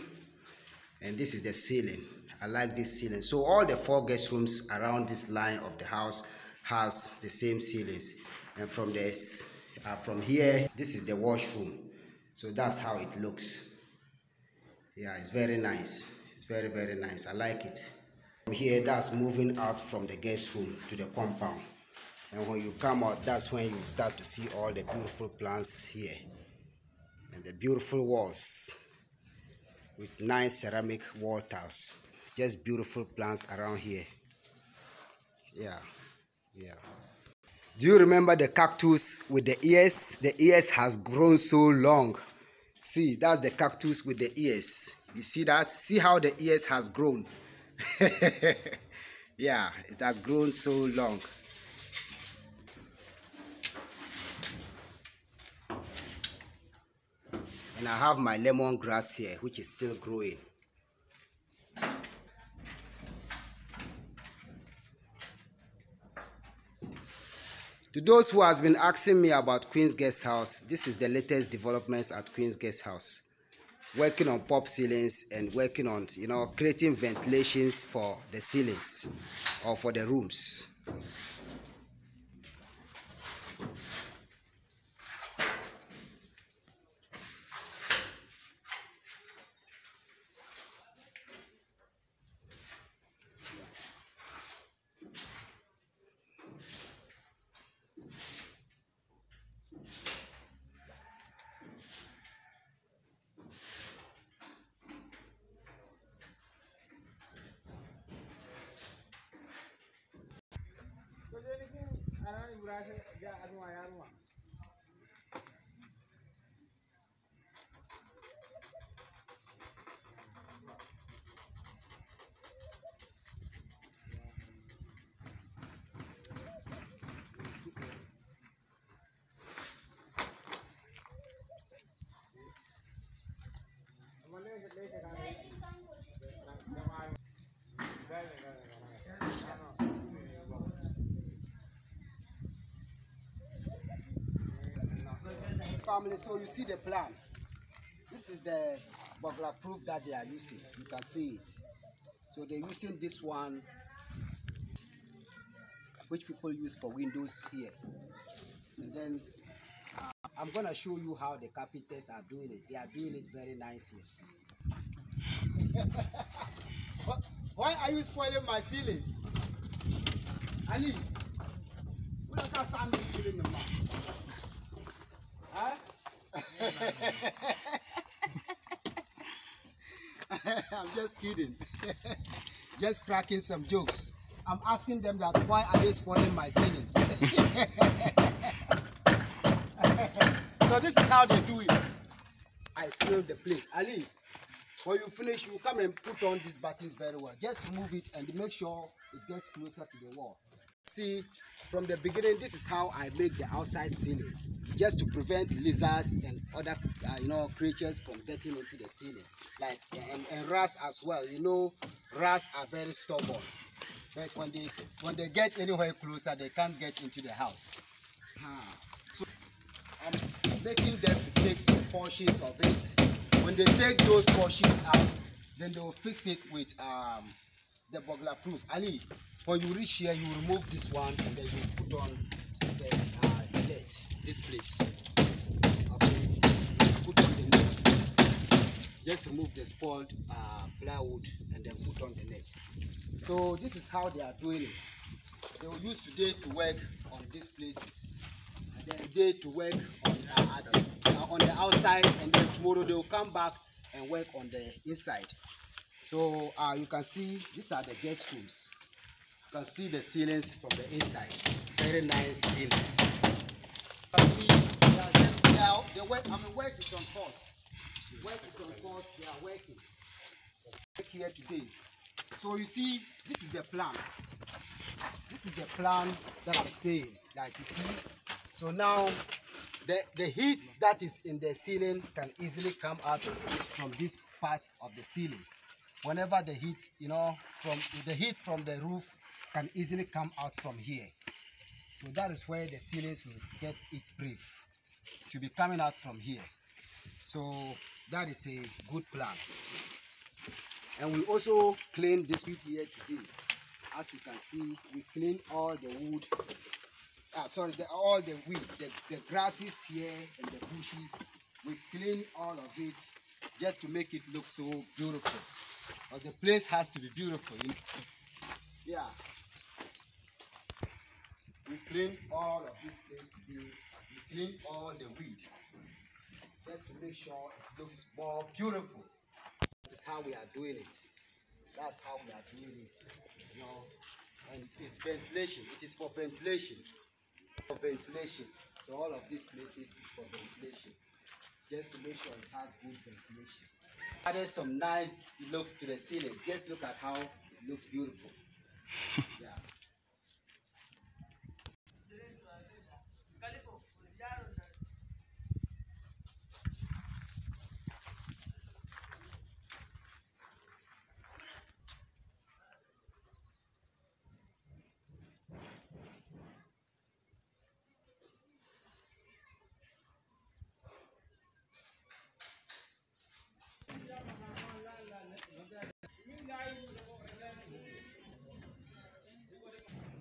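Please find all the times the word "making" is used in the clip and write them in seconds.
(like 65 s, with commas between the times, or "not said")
220 s.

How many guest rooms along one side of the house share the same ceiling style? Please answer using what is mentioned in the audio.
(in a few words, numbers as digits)
4.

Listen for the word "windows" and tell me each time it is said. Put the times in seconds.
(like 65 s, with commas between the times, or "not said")
156 s.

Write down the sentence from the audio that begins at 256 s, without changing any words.
So uh, you can see these are the guest rooms.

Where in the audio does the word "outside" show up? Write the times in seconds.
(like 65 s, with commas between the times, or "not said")
203 s, 251 s.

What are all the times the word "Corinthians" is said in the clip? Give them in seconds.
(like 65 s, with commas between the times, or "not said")
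not said.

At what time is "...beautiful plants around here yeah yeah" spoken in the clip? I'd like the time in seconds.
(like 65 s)
32 s.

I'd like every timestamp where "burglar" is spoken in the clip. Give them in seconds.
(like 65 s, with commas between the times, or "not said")
149 s, 228 s.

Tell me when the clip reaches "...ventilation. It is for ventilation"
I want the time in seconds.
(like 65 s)
335 s.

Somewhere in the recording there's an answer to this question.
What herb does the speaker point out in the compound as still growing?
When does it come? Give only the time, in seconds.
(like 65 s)
58 s.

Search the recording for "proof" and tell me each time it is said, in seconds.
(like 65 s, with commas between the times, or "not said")
149 s, 228 s.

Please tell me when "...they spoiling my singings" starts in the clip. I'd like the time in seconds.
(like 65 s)
185 s.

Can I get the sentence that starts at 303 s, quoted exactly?
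As you can see, we clean all the wood, ah, sorry, the, all the weed, the, the grasses here and the bushes.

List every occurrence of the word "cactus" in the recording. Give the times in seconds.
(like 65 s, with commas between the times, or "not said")
38 s, 43 s.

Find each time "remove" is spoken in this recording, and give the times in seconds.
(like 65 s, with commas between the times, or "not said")
230 s, 239 s.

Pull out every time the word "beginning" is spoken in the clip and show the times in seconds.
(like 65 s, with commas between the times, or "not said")
201 s.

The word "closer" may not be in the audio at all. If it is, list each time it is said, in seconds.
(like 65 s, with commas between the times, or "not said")
199 s, 215 s.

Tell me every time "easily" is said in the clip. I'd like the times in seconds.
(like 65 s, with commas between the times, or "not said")
282 s, 289 s.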